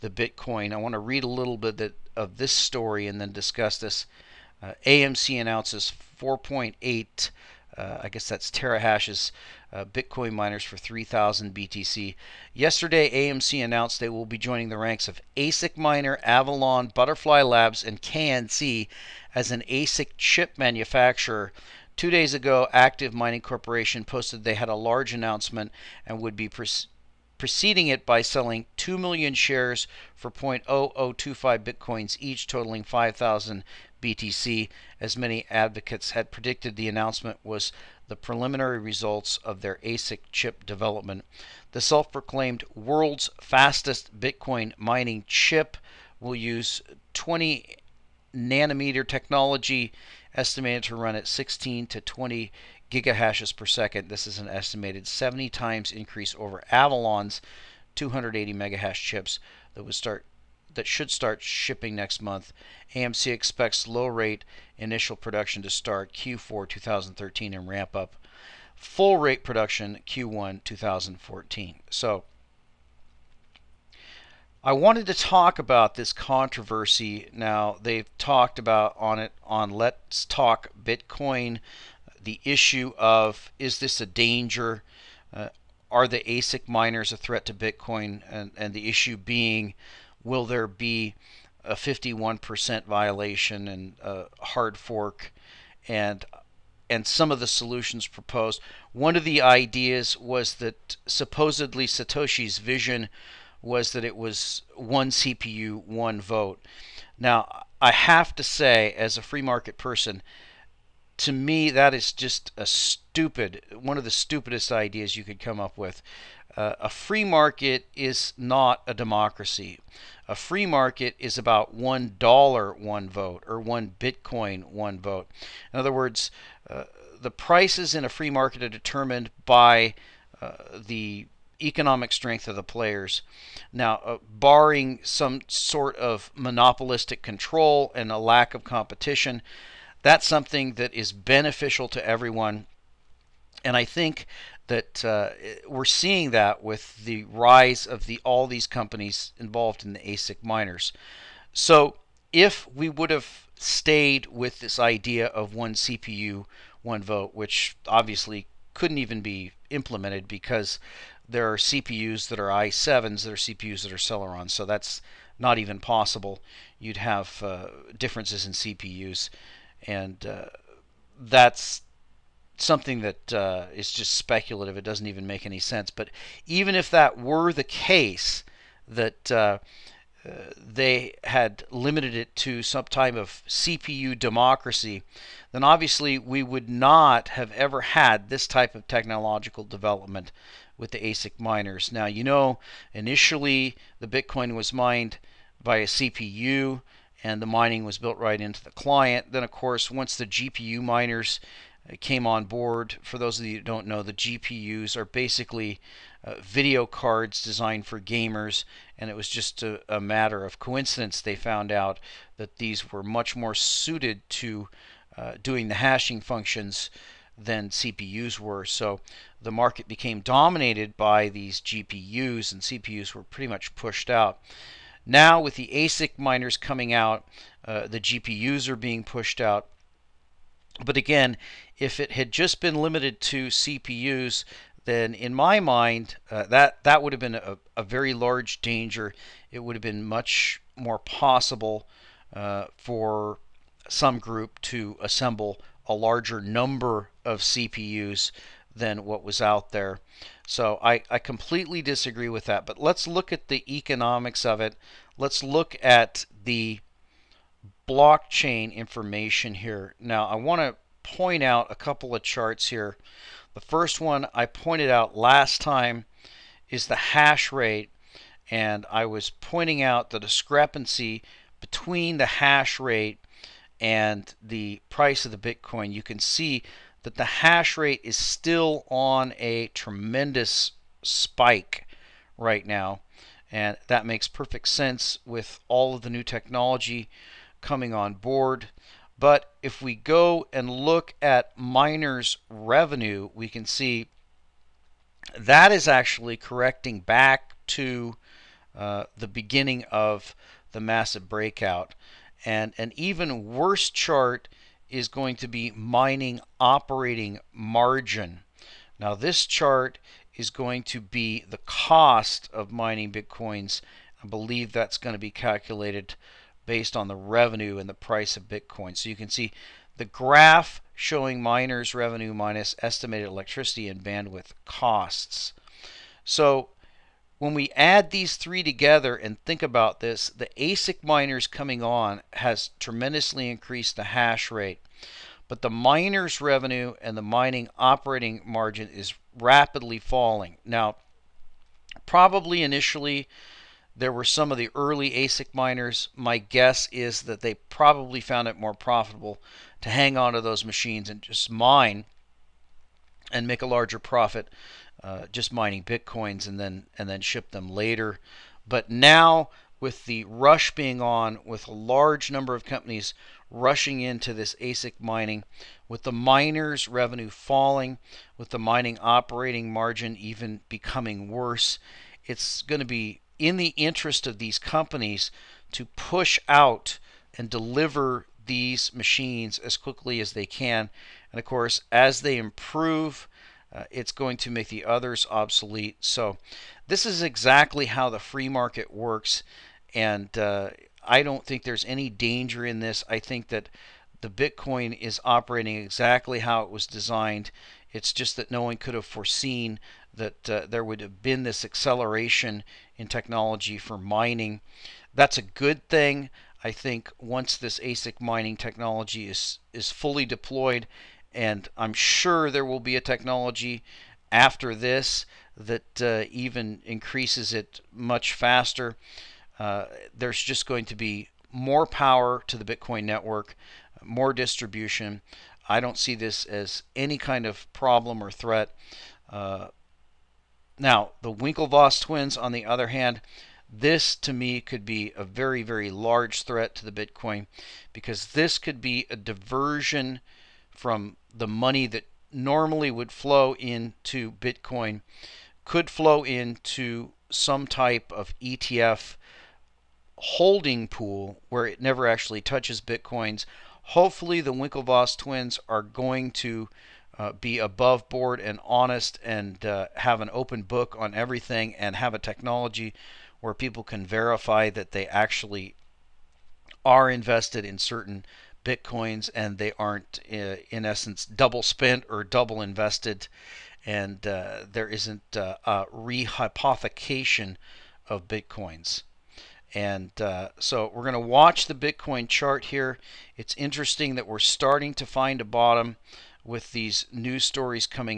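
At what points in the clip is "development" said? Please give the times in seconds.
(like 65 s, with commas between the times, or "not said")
40 s, 189 s.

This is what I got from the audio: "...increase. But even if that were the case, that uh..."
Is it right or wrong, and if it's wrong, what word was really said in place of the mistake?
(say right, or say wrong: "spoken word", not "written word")
wrong: "sense", not "increase".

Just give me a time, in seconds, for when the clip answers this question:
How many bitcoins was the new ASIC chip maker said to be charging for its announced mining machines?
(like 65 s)
10 s.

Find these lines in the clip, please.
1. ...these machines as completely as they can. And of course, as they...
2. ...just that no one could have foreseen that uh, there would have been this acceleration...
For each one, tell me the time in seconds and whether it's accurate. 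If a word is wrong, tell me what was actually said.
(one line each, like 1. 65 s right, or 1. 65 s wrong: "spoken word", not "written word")
1. 378 s wrong: "quickly", not "completely"
2. 398 s right.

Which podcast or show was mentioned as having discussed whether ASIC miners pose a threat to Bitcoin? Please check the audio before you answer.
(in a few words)
Let's Talk Bitcoin.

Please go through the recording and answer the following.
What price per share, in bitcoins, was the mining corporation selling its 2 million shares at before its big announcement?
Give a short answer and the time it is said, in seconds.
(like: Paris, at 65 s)
0.0025 bitcoins, at 30 s.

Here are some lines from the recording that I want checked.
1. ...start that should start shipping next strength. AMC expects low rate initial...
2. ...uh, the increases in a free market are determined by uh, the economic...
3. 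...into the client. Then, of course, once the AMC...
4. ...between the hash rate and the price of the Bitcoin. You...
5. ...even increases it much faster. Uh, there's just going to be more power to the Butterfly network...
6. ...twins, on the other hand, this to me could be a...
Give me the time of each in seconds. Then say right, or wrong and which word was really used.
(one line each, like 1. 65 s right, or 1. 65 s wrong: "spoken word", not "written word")
1. 59 s wrong: "month", not "strength"
2. 126 s wrong: "prices", not "increases"
3. 198 s wrong: "GPU", not "AMC"
4. 271 s right
5. 416 s wrong: "Bitcoin", not "Butterfly"
6. 431 s right.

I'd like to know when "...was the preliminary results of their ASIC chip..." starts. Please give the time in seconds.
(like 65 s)
37 s.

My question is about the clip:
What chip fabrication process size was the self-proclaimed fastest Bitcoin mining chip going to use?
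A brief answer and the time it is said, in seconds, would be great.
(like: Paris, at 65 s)
20 nanometer, at 47 s.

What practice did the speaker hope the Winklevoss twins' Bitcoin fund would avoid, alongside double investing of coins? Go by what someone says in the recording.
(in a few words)
rehypothecation.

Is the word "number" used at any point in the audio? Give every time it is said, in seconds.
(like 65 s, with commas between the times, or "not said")
246 s, 362 s.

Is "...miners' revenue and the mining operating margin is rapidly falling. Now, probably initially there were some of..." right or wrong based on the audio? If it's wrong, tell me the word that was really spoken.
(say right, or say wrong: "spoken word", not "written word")
right.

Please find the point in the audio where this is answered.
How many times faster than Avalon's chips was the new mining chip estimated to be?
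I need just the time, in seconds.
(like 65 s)
55 s.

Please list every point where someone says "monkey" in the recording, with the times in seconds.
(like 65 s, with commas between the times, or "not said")
not said.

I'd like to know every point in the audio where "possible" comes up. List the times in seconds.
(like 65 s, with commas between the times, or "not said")
165 s, 240 s.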